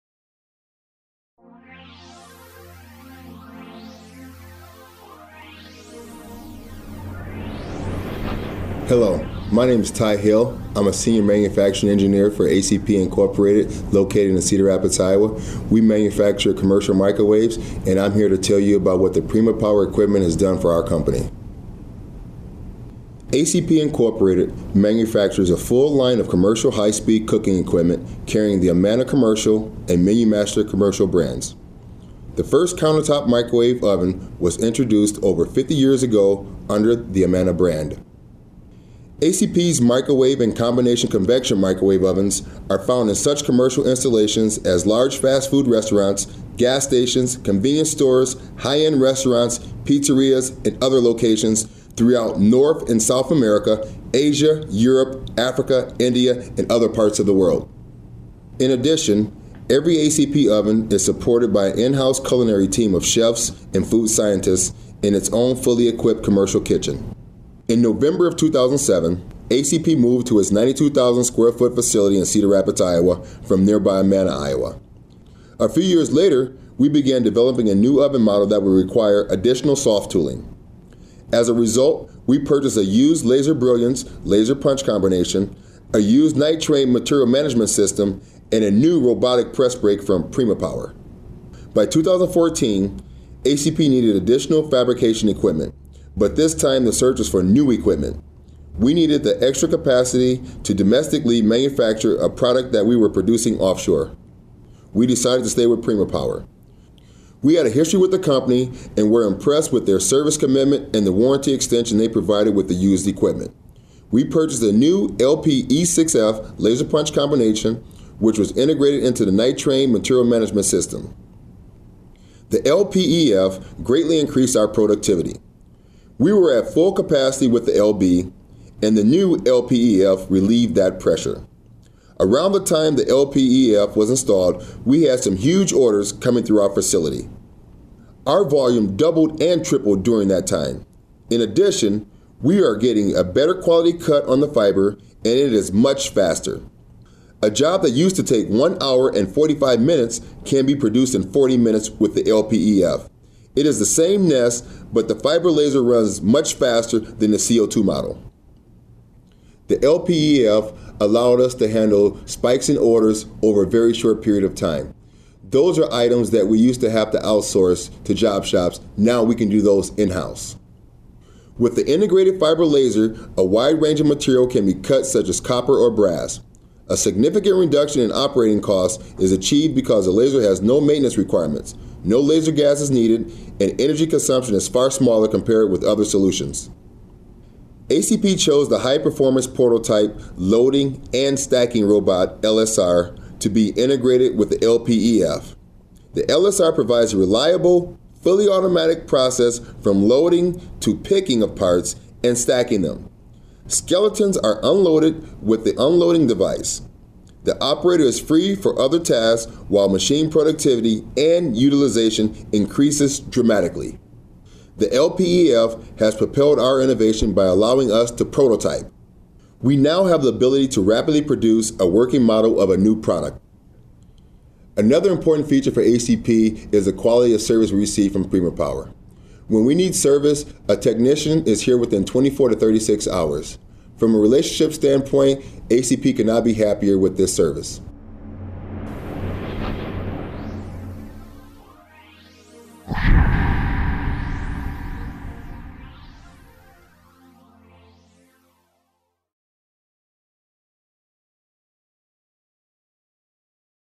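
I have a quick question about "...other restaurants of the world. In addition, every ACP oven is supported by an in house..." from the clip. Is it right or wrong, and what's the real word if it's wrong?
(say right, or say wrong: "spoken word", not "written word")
wrong: "parts", not "restaurants".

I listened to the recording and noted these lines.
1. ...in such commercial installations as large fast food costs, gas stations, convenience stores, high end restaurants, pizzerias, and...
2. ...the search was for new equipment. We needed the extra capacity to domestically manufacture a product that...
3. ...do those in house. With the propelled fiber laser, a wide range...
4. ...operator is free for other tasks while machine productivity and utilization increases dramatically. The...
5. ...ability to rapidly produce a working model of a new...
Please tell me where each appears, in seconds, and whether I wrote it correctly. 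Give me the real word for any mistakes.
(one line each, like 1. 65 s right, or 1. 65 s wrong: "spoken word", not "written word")
1. 43 s wrong: "restaurants", not "costs"
2. 96 s right
3. 169 s wrong: "integrated", not "propelled"
4. 207 s right
5. 220 s right.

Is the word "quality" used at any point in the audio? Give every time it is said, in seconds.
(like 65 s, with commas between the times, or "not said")
143 s, 226 s.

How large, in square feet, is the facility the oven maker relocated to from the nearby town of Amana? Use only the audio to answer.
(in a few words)
92,000.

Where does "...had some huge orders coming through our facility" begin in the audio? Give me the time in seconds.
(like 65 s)
135 s.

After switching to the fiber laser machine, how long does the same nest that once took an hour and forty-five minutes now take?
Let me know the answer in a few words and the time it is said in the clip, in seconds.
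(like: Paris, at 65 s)
40 minutes, at 151 s.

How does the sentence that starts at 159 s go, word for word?
The LPEF allowed us to handle spikes in orders over a very short period of time.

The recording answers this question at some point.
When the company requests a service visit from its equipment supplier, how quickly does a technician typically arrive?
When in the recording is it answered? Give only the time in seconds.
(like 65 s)
232 s.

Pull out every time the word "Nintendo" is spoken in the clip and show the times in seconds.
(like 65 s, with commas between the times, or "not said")
not said.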